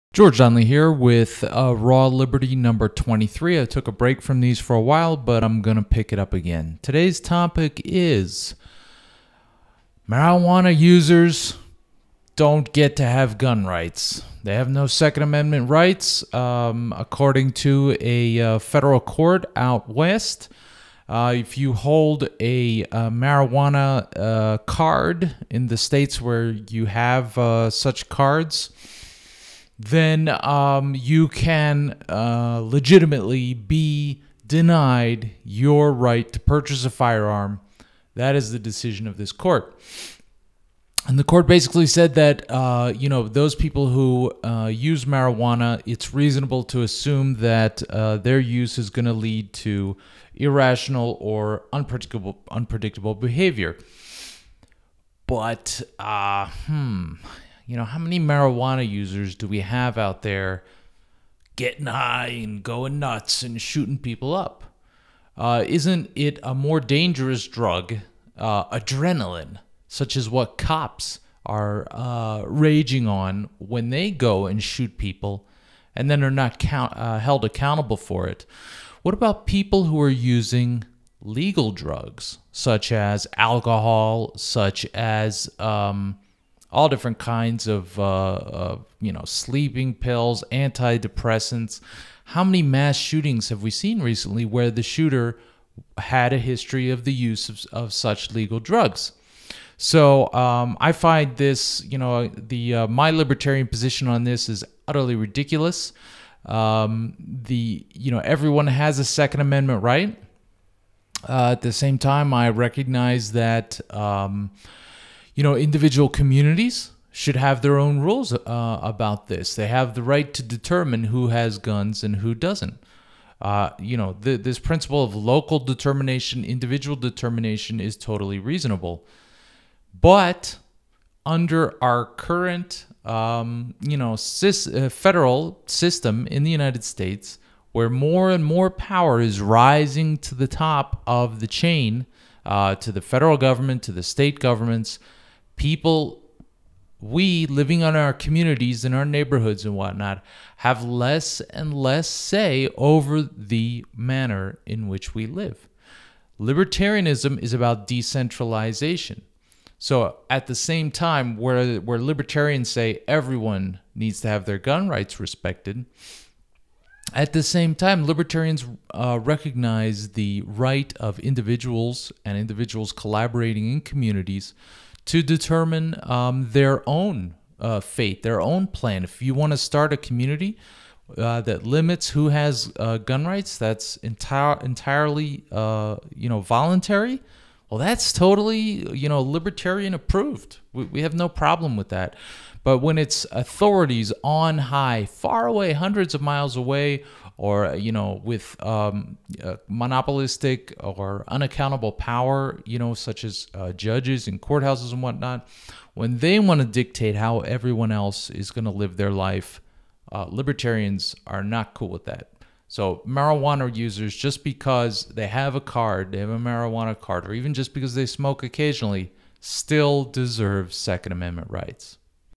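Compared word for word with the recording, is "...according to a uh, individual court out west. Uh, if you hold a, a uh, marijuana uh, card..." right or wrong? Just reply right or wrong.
wrong.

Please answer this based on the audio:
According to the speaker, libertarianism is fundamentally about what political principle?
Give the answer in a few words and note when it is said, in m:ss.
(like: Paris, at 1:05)
decentralization, at 2:37.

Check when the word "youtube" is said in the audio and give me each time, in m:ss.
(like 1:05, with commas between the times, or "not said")
not said.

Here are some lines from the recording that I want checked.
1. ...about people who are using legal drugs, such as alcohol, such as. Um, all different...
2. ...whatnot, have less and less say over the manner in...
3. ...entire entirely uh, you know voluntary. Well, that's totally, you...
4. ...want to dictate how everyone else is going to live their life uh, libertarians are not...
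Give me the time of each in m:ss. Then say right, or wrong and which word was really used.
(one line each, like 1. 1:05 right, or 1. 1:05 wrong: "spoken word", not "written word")
1. 1:19 right
2. 2:29 right
3. 3:03 right
4. 3:26 right.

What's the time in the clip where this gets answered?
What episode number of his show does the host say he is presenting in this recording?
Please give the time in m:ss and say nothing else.
0:02.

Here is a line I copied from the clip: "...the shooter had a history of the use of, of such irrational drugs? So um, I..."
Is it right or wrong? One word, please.
wrong.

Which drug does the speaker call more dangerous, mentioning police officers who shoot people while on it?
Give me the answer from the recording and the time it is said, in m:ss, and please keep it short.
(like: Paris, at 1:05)
adrenaline, at 1:08.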